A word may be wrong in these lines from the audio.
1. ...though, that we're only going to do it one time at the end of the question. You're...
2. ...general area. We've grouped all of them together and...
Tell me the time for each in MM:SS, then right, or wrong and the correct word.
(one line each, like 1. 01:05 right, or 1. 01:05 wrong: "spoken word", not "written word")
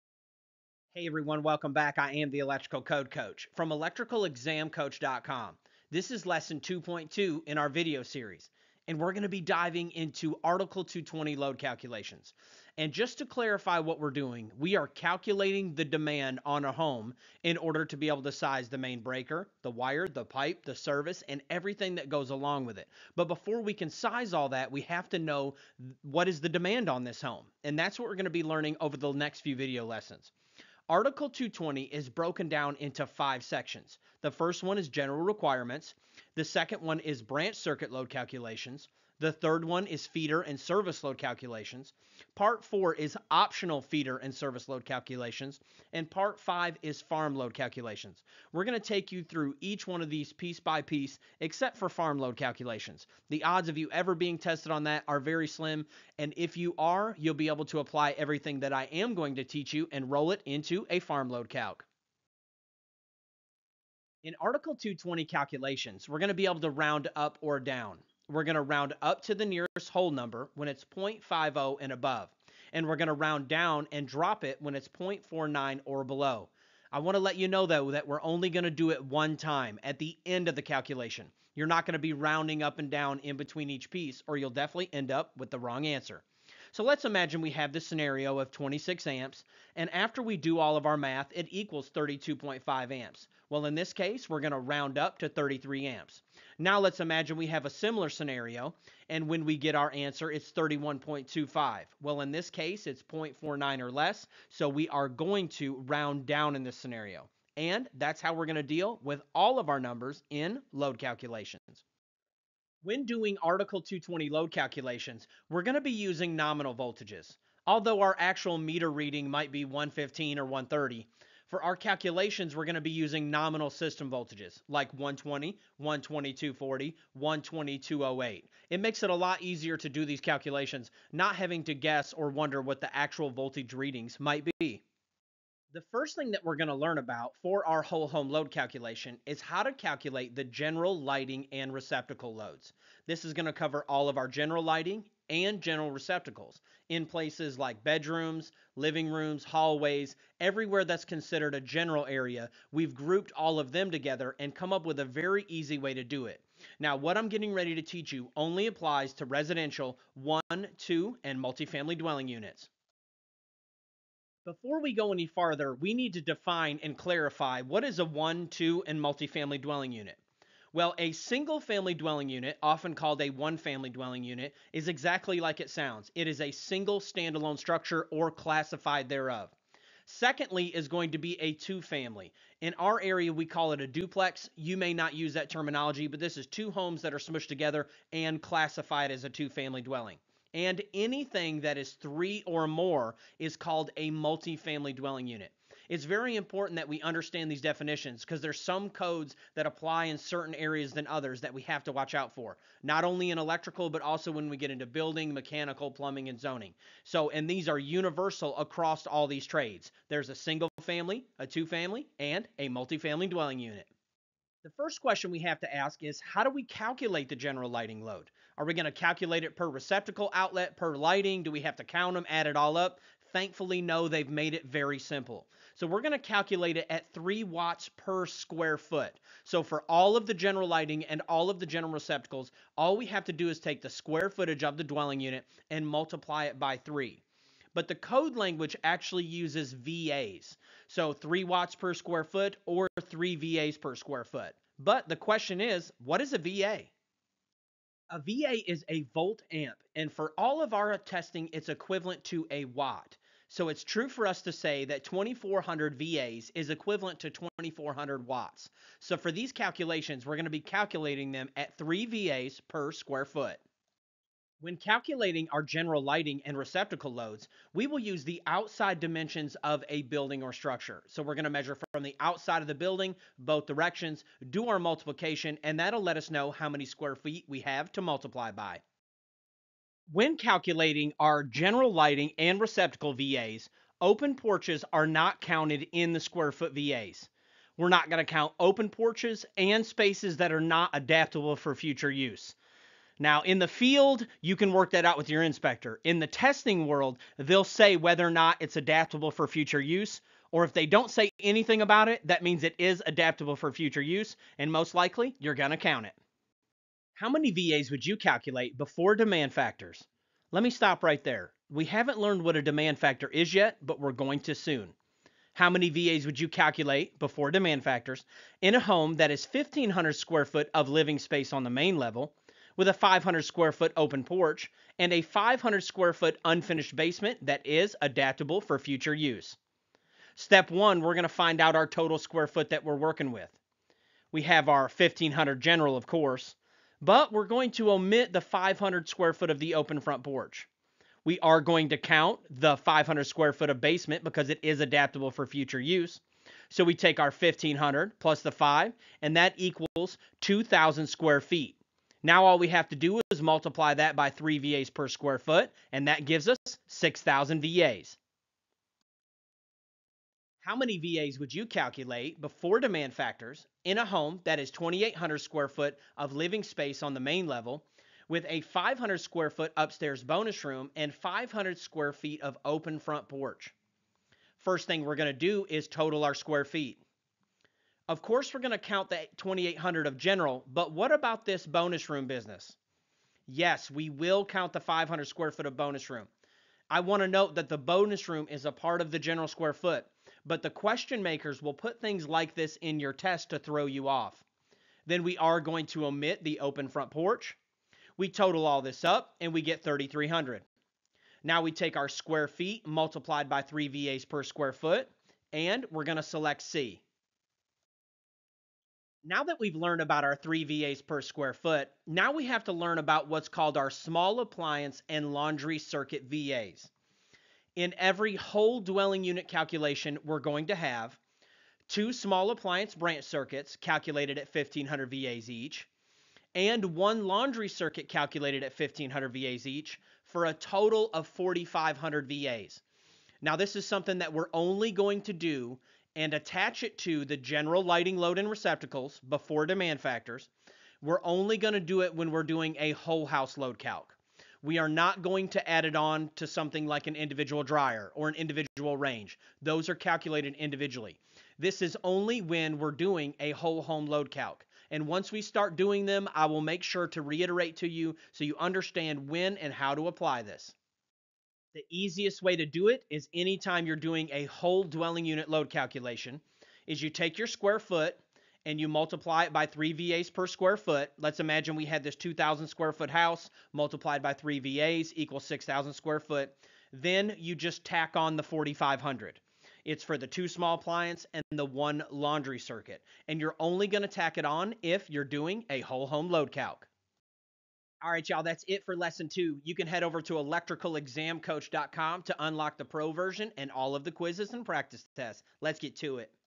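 1. 01:17 wrong: "calculation", not "question"
2. 02:31 right.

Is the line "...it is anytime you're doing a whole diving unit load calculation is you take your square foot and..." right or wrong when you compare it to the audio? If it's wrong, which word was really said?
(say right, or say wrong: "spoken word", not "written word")
wrong: "dwelling", not "diving".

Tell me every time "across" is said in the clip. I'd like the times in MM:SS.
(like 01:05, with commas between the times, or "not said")
03:28.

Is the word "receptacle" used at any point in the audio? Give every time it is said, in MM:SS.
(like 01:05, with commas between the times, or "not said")
02:21, 02:25, 03:39, 03:51, 04:26, 04:42, 07:18.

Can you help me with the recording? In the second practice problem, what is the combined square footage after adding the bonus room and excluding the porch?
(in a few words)
3,300.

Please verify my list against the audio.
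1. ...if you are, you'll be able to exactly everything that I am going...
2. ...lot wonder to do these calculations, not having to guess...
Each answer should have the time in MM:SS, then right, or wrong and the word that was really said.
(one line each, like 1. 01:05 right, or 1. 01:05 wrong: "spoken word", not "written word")
1. 00:56 wrong: "apply", not "exactly"
2. 02:09 wrong: "easier", not "wonder".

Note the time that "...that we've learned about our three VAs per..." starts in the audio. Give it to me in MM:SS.
06:49.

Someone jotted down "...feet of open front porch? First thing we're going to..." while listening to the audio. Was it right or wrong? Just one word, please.
right.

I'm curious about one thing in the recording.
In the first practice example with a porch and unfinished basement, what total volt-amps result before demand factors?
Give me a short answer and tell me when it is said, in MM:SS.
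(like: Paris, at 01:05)
6,000 VAs, at 05:56.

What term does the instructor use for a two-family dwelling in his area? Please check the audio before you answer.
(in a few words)
Duplex.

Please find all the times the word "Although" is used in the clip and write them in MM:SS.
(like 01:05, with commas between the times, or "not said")
01:57.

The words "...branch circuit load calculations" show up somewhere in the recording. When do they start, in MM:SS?
00:37.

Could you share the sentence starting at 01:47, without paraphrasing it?
And that's how we're going to deal with all of our numbers in load calculations.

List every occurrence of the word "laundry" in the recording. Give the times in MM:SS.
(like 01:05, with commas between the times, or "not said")
06:55, 07:07, 08:02.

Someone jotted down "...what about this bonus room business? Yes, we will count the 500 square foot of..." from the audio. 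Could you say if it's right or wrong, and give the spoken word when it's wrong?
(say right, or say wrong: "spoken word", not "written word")
right.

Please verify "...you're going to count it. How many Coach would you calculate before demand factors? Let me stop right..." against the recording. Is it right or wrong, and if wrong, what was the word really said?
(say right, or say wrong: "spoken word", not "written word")
wrong: "VAs", not "Coach".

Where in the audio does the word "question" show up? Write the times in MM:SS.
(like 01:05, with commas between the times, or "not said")
03:35, 04:05, 06:30.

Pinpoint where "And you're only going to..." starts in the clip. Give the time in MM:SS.
08:03.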